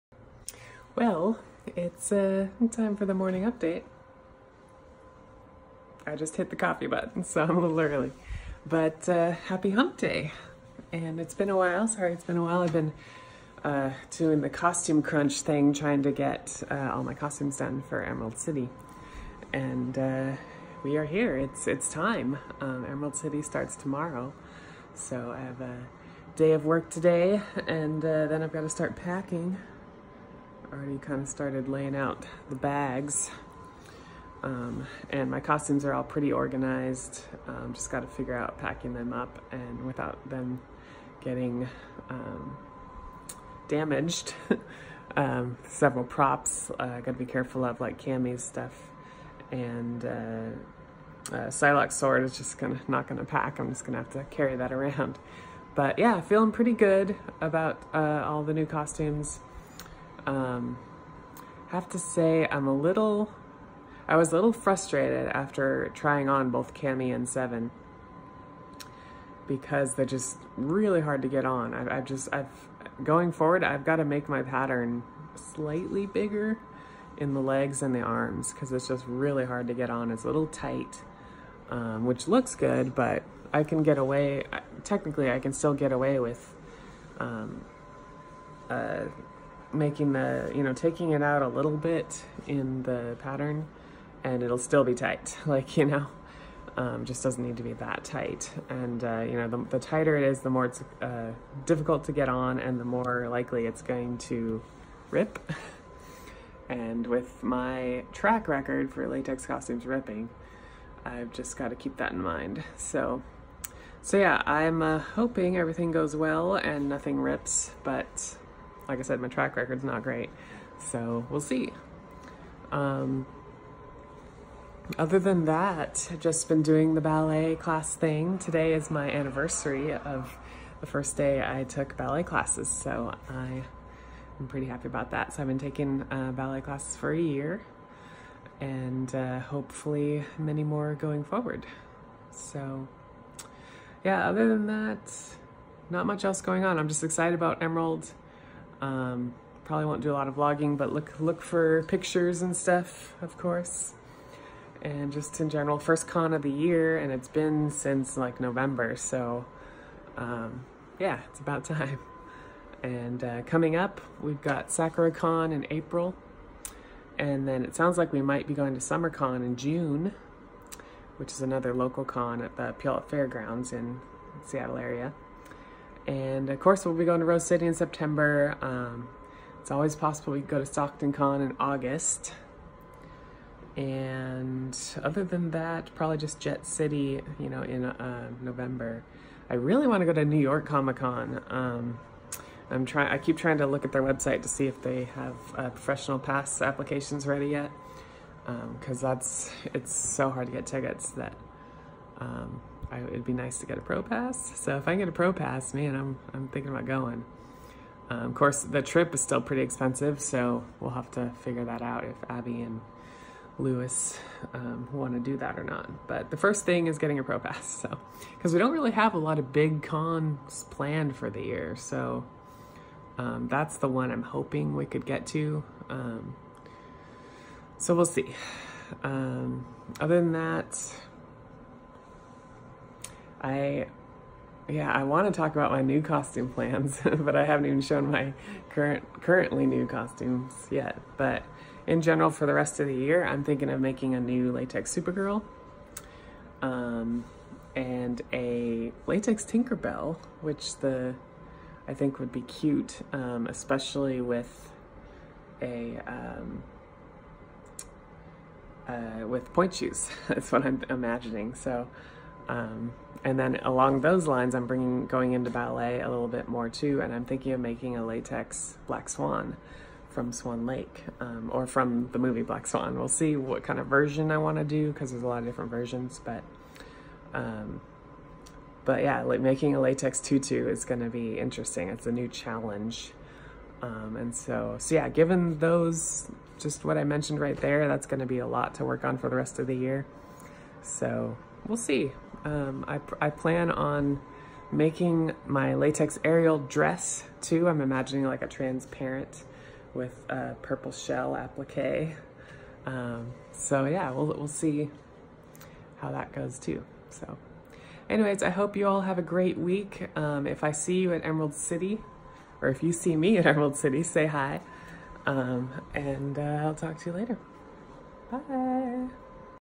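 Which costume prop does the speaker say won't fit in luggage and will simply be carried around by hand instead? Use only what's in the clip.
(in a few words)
Psylocke sword.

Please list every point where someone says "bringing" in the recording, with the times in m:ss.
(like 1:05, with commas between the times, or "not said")
4:24.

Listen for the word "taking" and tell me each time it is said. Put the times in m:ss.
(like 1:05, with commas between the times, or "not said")
1:30, 2:15.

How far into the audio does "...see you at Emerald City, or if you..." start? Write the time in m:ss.
5:10.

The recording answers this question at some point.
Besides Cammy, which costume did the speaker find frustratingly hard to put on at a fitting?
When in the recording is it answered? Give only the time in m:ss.
1:07.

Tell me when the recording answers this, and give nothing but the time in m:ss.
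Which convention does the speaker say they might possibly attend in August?
3:00.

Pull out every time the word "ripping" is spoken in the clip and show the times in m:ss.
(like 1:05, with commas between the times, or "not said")
1:49.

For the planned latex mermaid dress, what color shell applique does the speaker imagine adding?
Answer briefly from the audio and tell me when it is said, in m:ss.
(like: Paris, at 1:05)
purple, at 5:00.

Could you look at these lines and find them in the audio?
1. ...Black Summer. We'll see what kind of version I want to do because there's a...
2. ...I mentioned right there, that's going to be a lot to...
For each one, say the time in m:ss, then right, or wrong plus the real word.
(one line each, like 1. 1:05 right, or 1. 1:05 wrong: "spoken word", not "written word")
1. 4:32 wrong: "Swan", not "Summer"
2. 4:46 right.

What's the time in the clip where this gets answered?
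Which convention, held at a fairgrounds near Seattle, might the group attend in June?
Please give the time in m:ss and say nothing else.
2:48.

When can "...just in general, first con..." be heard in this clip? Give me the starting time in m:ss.
2:35.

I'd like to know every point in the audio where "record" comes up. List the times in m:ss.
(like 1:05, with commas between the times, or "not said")
1:48, 1:59.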